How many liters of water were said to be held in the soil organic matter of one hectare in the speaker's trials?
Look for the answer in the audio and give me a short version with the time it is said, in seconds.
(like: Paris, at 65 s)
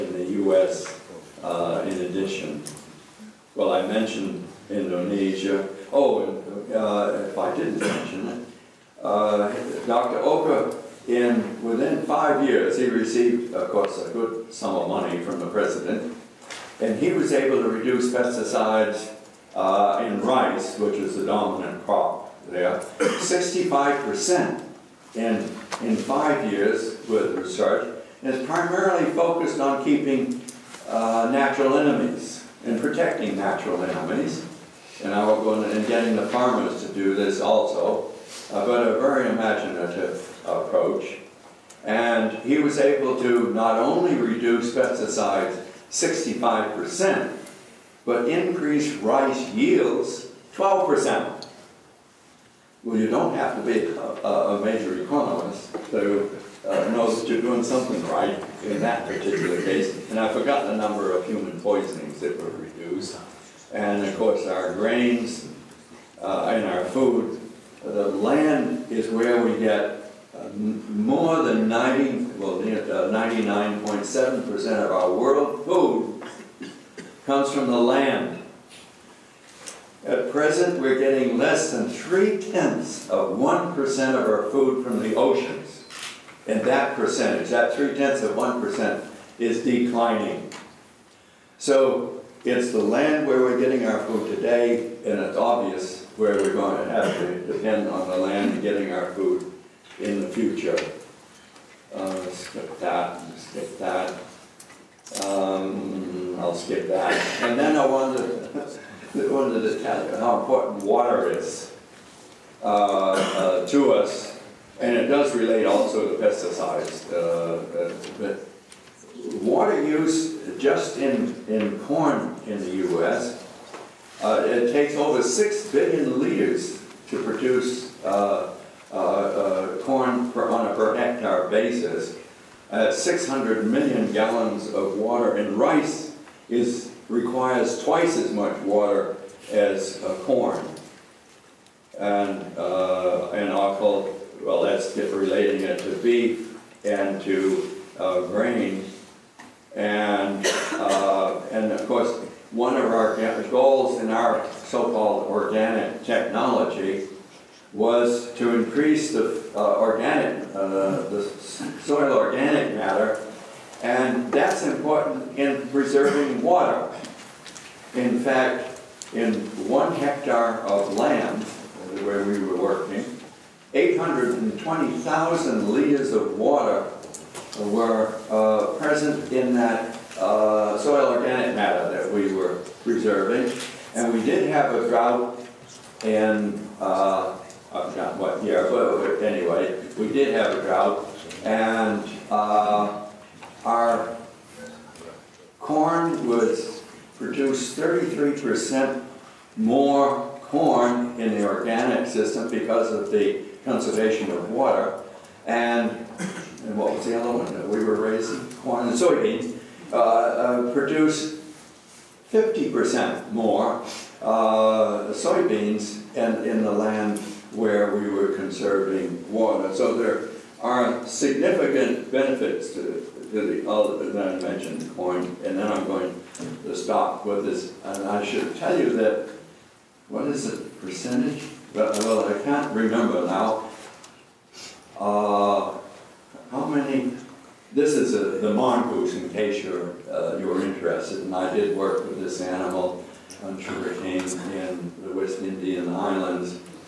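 820,000 liters, at 173 s.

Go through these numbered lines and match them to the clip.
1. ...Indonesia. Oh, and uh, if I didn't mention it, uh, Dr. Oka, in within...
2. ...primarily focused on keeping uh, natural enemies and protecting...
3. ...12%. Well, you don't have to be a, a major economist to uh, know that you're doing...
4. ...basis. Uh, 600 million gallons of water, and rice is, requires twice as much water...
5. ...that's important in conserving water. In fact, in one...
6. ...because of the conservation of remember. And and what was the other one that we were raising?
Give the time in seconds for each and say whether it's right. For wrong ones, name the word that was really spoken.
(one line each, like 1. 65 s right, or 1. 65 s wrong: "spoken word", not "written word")
1. 4 s right
2. 28 s right
3. 50 s right
4. 131 s right
5. 164 s wrong: "preserving", not "conserving"
6. 202 s wrong: "water", not "remember".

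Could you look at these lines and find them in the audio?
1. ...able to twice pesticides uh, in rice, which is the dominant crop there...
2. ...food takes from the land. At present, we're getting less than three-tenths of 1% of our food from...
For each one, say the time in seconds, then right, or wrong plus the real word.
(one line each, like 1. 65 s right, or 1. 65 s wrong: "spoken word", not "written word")
1. 17 s wrong: "reduce", not "twice"
2. 75 s wrong: "comes", not "takes".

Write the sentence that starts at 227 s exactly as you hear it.
And I should tell you that, what is the percentage?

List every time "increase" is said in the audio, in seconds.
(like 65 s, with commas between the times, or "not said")
48 s, 158 s.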